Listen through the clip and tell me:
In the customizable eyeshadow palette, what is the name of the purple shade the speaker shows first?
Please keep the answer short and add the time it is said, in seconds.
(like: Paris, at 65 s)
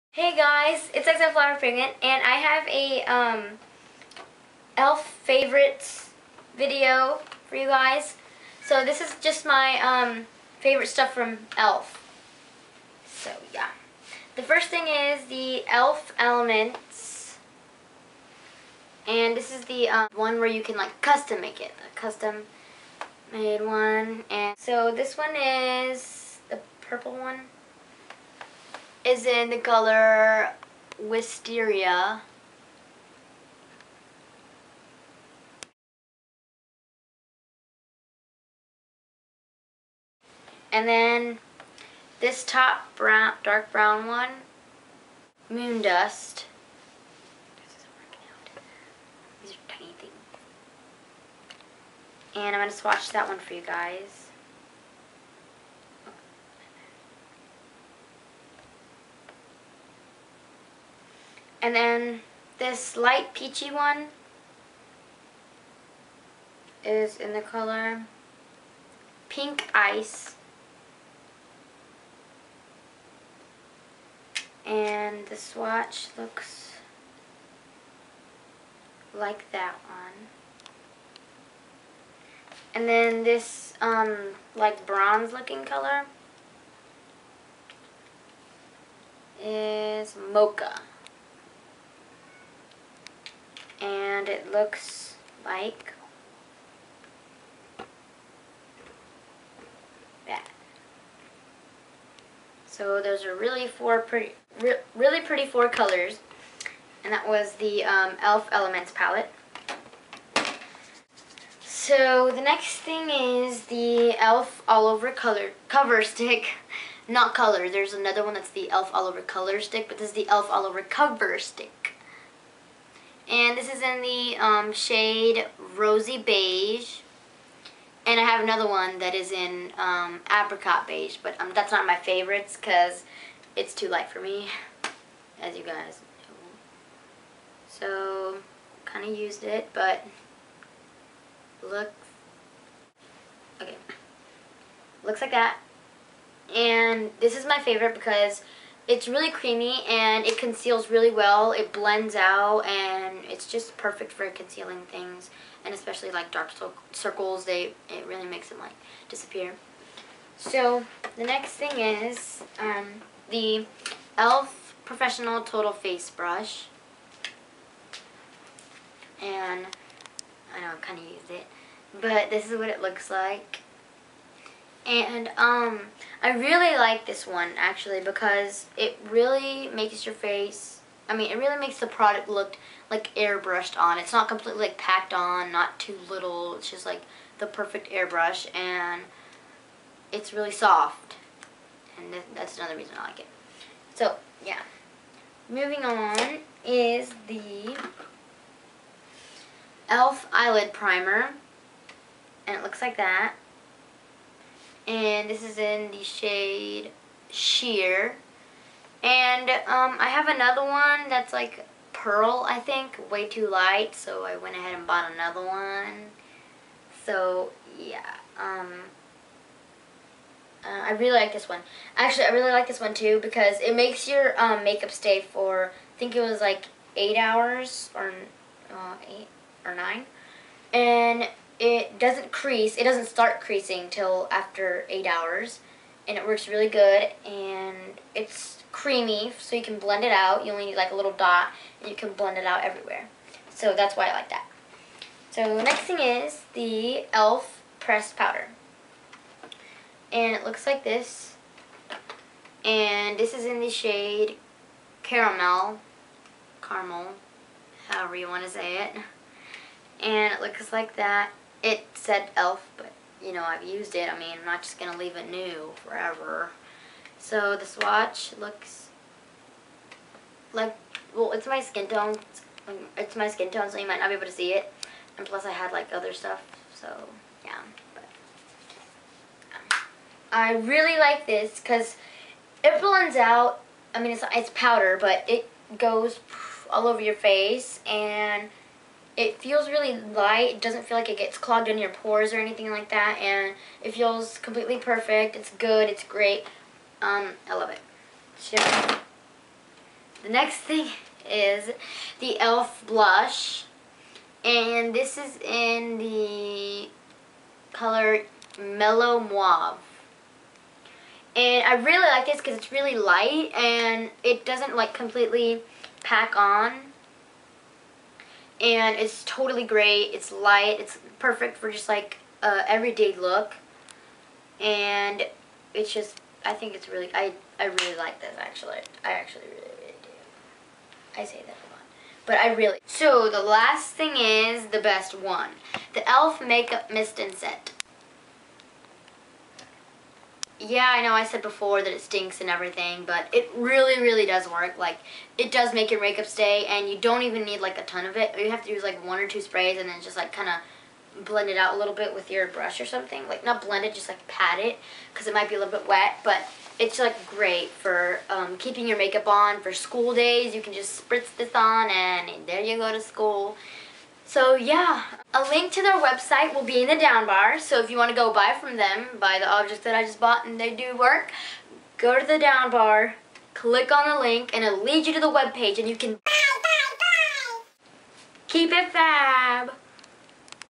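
Wisteria, at 31 s.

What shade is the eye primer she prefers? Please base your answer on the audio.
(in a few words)
Sheer.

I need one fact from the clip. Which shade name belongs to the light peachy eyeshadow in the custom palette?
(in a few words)
Pink Ice.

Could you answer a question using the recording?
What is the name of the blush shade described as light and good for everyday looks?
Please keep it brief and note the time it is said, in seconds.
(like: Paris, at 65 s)
Mellow Mauve, at 308 s.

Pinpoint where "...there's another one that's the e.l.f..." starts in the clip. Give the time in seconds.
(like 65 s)
117 s.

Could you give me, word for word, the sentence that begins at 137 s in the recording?
So, kind of used it, but looks, okay, looks like that.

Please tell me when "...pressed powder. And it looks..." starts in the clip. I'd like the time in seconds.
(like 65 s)
247 s.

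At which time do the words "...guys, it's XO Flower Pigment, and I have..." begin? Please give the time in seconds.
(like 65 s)
0 s.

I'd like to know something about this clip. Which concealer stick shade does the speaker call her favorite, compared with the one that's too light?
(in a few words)
Rosy Beige.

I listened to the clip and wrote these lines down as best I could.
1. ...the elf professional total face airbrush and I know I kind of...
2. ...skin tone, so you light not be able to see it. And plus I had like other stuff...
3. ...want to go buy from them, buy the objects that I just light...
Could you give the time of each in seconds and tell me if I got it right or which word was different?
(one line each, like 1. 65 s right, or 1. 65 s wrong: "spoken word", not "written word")
1. 163 s wrong: "brush", not "airbrush"
2. 273 s wrong: "might", not "light"
3. 367 s wrong: "bought", not "light".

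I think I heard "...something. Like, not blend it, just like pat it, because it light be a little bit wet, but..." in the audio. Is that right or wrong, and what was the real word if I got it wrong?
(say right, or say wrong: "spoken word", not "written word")
wrong: "might", not "light".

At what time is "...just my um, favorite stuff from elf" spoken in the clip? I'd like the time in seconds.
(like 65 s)
9 s.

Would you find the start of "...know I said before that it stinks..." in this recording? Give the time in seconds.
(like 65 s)
341 s.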